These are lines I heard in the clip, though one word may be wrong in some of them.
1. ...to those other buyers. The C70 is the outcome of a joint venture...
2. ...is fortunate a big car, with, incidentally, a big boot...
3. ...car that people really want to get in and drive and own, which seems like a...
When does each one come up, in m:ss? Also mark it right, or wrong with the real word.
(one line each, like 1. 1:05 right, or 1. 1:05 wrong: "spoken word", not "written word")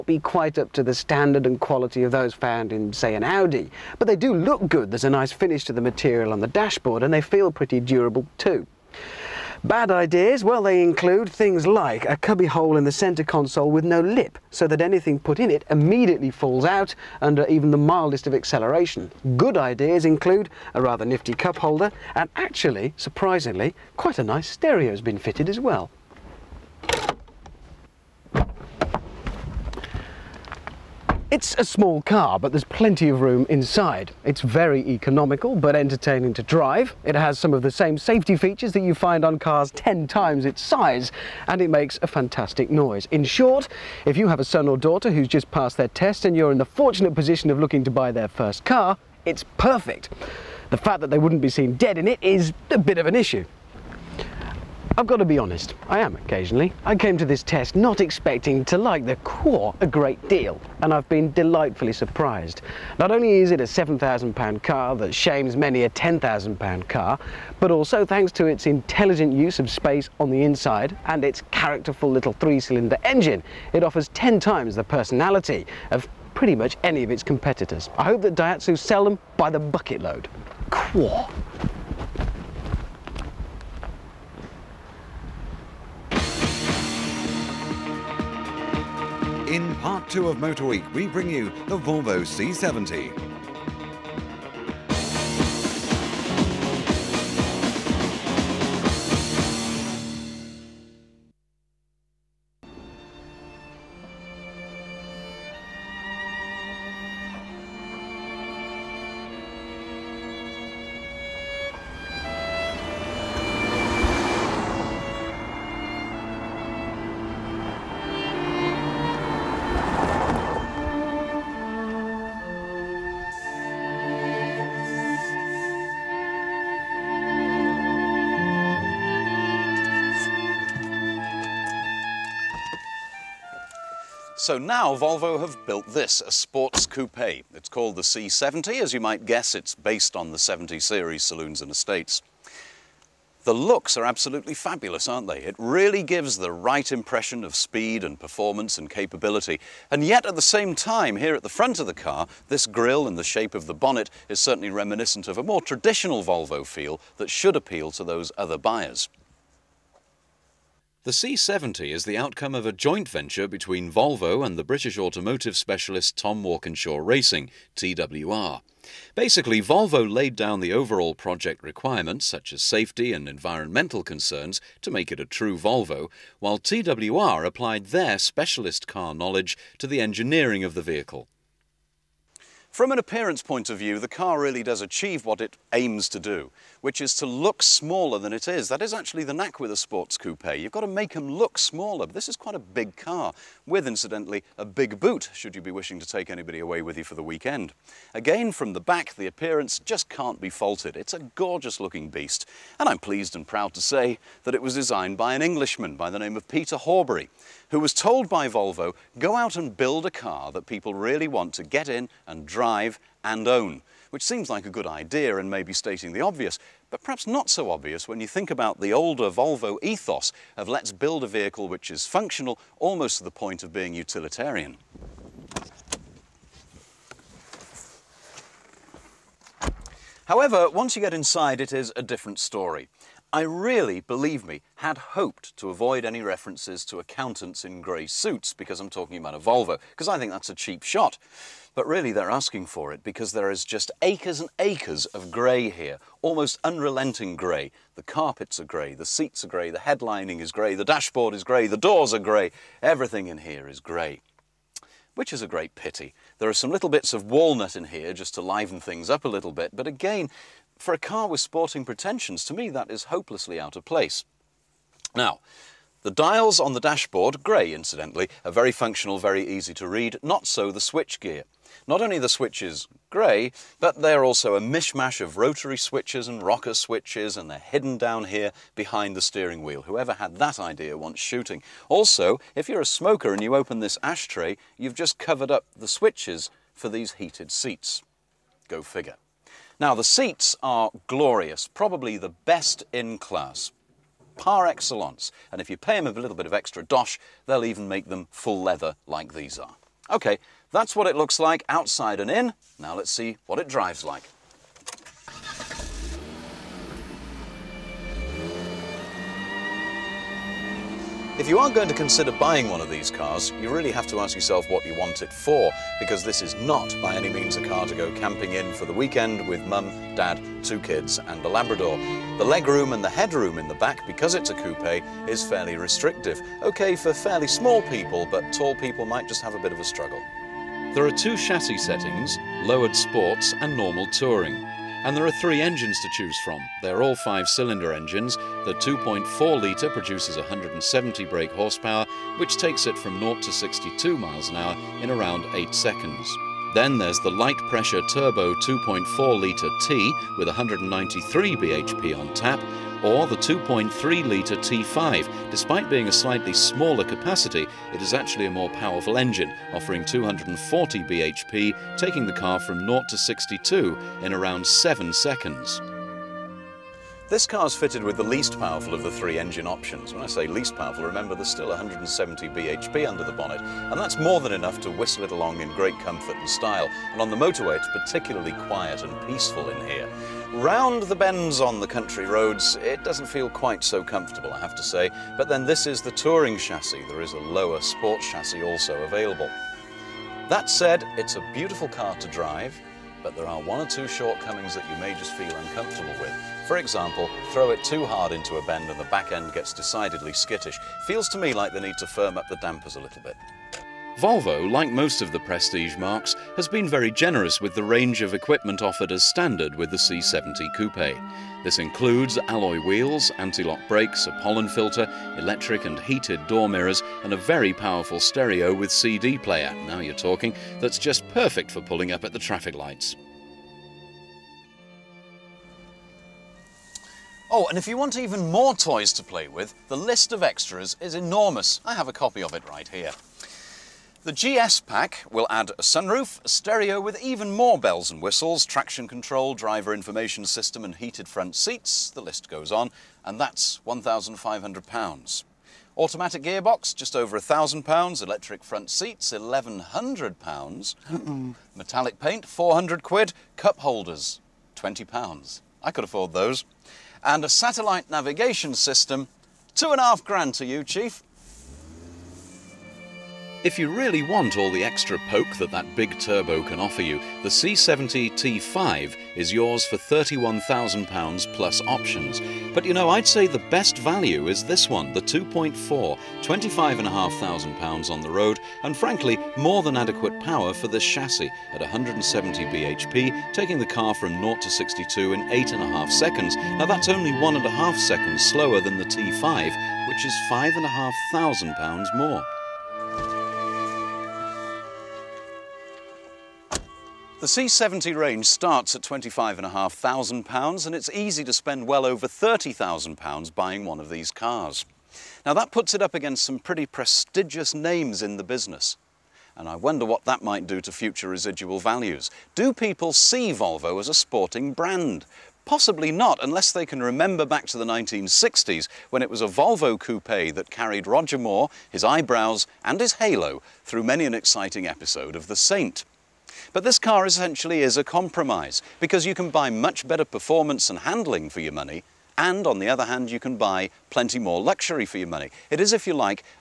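1. 2:37 right
2. 3:12 wrong: "quite", not "fortunate"
3. 3:30 right.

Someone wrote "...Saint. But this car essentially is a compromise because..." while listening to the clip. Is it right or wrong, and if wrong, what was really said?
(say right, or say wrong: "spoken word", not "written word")
right.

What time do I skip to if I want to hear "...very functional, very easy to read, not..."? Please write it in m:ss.
4:28.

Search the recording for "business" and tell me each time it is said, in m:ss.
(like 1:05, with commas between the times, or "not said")
8:28.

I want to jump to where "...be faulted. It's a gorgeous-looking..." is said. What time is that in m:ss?
3:20.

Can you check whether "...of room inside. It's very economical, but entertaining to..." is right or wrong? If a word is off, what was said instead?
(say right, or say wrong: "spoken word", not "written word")
right.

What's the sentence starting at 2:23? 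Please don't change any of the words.
The looks are absolutely fabulous, aren't they?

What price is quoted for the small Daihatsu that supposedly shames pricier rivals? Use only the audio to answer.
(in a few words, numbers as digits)
£7,000.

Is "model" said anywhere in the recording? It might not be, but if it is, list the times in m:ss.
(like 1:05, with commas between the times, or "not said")
not said.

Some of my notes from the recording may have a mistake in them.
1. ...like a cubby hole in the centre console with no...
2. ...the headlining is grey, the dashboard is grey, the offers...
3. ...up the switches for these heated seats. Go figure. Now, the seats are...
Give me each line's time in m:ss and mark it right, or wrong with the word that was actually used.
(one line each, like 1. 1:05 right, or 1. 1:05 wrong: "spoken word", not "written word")
1. 0:11 right
2. 4:09 wrong: "doors", not "offers"
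3. 4:45 right.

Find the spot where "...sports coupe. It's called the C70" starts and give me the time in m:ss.
2:16.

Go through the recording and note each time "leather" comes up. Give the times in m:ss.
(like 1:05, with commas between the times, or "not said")
4:58.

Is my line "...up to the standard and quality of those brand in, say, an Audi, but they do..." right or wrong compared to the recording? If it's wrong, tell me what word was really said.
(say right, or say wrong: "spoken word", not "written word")
wrong: "found", not "brand".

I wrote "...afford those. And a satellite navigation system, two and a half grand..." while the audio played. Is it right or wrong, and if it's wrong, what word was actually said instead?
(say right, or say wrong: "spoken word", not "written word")
right.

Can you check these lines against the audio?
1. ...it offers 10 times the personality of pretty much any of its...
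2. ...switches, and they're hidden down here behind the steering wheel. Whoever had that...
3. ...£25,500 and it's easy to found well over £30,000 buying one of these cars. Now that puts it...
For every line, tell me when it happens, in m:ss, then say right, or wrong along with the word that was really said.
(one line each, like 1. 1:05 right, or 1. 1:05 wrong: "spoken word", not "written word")
1. 1:13 right
2. 4:36 right
3. 8:19 wrong: "spend", not "found".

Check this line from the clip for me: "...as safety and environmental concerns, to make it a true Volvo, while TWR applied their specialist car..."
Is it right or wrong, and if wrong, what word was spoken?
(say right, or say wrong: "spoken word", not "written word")
right.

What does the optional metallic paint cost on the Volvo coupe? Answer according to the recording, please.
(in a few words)
£400.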